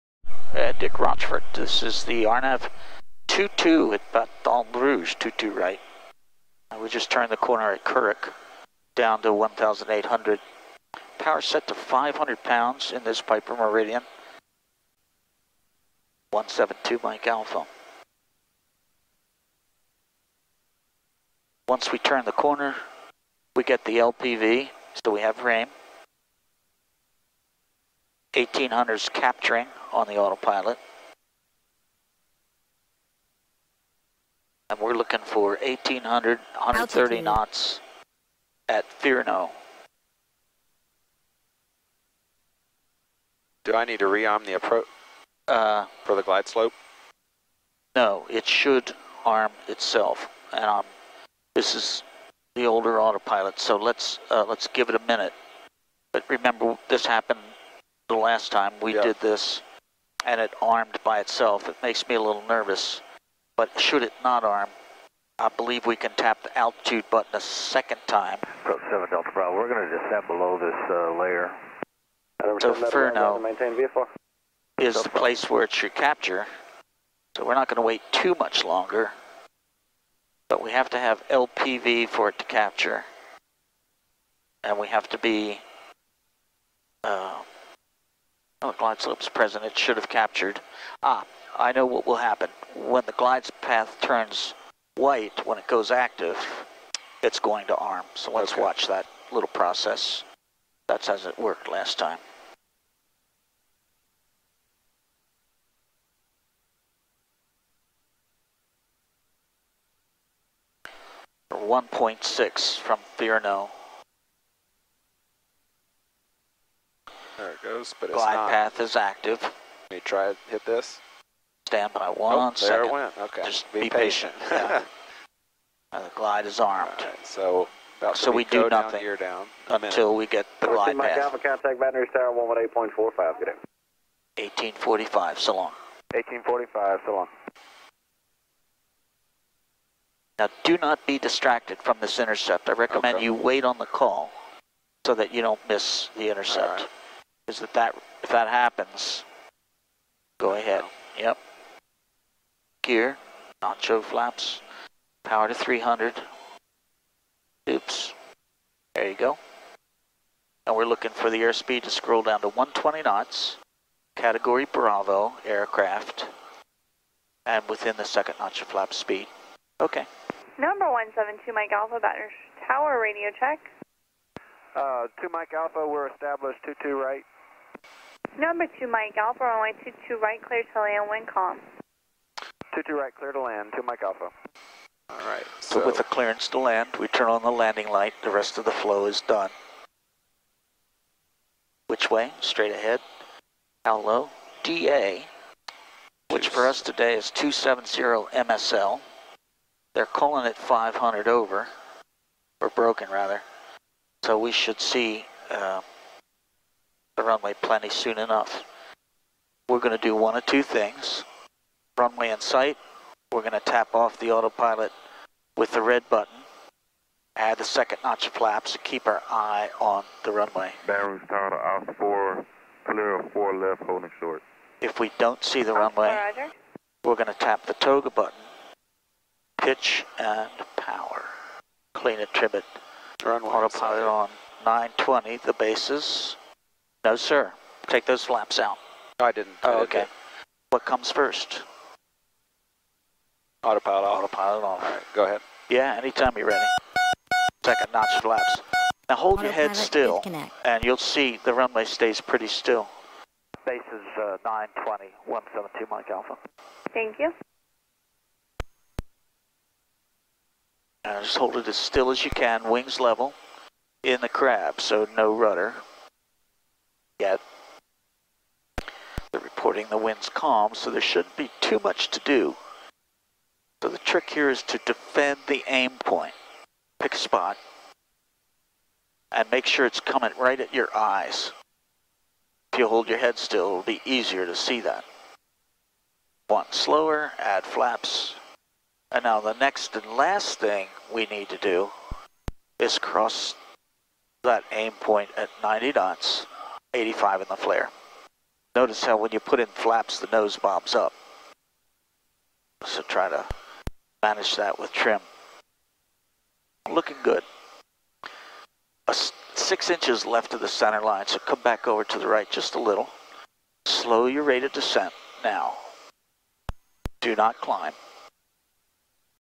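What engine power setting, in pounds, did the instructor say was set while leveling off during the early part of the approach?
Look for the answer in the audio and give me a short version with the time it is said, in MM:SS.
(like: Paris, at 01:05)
500 pounds, at 00:11.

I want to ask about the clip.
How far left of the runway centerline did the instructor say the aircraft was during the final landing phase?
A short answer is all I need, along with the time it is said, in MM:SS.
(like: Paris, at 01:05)
6 inches, at 05:09.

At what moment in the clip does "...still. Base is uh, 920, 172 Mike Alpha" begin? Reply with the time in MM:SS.
04:12.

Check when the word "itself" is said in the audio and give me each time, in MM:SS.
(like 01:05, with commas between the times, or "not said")
00:49, 01:01.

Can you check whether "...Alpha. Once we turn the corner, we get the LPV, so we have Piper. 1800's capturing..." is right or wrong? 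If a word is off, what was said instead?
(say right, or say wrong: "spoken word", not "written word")
wrong: "RAIM", not "Piper".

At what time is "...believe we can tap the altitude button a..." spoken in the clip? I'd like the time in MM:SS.
01:05.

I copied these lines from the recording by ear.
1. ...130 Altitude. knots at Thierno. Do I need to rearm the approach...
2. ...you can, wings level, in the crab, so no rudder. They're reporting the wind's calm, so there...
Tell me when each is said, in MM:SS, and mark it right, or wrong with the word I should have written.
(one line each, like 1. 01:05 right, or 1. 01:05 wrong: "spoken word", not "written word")
1. 00:36 right
2. 04:22 right.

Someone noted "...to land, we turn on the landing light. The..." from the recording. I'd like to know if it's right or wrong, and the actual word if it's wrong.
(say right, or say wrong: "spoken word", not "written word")
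right.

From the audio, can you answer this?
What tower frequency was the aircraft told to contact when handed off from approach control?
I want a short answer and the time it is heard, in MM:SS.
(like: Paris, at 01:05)
118.45, at 02:12.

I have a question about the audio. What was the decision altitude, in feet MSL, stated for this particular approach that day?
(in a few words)
270 MSL.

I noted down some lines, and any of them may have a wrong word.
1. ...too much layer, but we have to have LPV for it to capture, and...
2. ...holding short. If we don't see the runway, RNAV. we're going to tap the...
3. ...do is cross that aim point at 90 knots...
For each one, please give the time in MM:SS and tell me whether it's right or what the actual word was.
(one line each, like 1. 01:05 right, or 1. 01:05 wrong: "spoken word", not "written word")
1. 01:18 wrong: "longer", not "layer"
2. 03:43 wrong: "Roger", not "RNAV"
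3. 04:51 right.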